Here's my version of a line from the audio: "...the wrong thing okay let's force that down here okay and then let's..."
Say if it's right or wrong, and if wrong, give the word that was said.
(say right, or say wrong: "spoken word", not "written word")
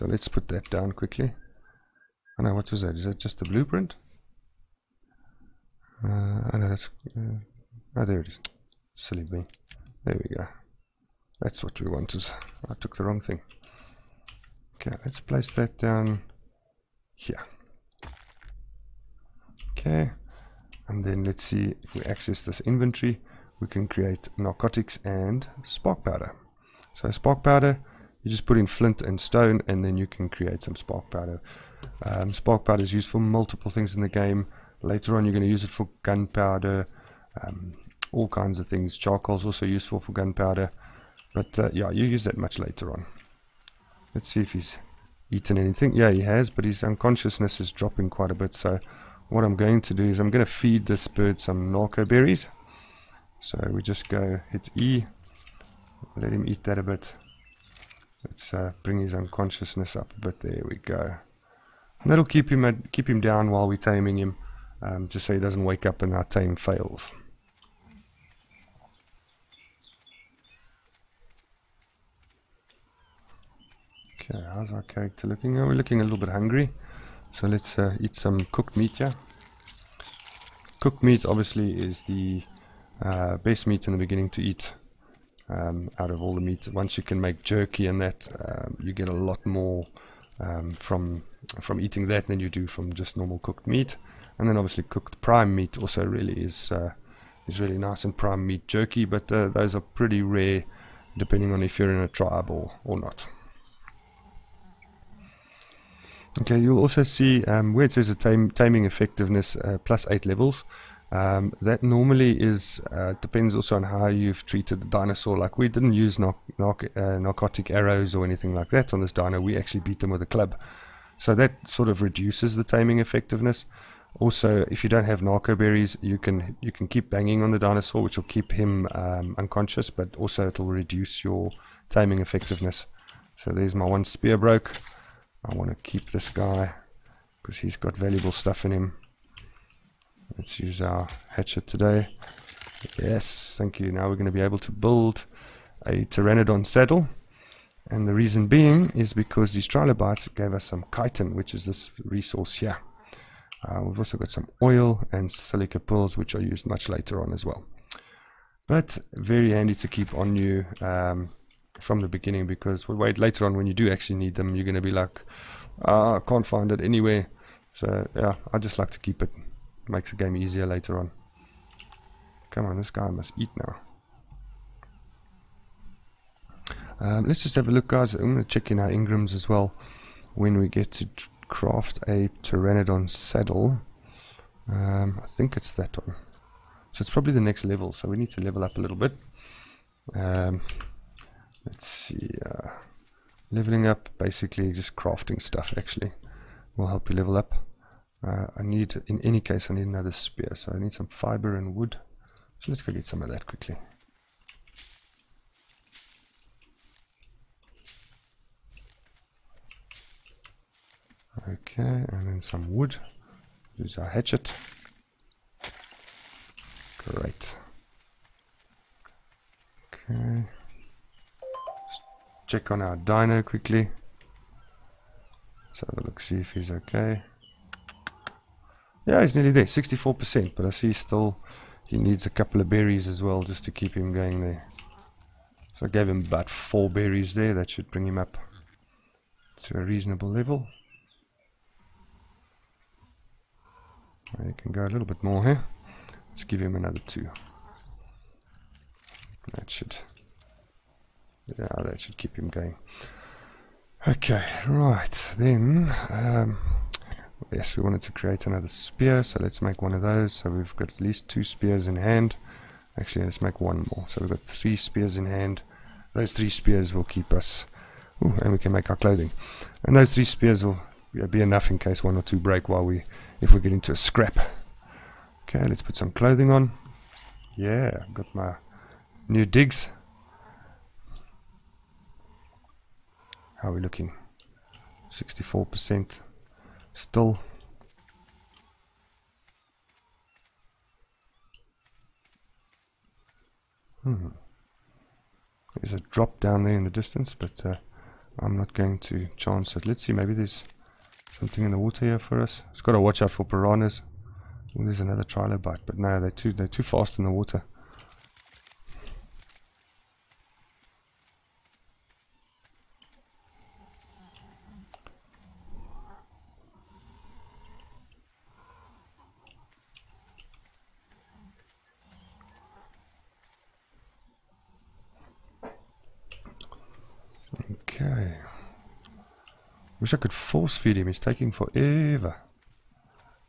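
wrong: "place", not "force".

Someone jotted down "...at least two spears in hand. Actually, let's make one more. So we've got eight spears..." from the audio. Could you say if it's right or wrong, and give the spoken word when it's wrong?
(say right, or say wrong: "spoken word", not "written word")
wrong: "three", not "eight".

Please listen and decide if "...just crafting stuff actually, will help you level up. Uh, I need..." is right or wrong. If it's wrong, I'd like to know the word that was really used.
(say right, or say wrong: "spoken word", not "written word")
right.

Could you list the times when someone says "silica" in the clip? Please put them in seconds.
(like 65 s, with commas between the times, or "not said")
155 s.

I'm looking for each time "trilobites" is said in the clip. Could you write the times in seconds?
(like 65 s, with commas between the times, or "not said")
149 s, 305 s.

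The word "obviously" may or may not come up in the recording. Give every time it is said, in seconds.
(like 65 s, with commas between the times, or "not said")
81 s, 94 s.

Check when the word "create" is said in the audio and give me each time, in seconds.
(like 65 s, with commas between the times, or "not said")
23 s, 30 s, 258 s.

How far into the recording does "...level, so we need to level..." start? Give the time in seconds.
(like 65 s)
187 s.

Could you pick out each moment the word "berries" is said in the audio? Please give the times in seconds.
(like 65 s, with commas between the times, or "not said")
52 s, 125 s, 232 s, 236 s.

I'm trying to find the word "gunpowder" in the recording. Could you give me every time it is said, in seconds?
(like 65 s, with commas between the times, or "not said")
36 s, 40 s.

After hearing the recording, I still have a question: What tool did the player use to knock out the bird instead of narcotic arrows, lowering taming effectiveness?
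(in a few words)
A club.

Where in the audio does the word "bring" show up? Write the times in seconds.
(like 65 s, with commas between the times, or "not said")
58 s, 237 s.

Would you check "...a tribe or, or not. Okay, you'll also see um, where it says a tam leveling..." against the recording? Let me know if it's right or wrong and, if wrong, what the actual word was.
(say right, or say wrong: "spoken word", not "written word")
wrong: "taming", not "leveling".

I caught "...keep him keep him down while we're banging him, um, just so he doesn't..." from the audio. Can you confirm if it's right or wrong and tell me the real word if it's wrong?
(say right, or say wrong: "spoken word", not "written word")
wrong: "taming", not "banging".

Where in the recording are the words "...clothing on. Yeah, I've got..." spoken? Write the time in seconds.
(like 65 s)
276 s.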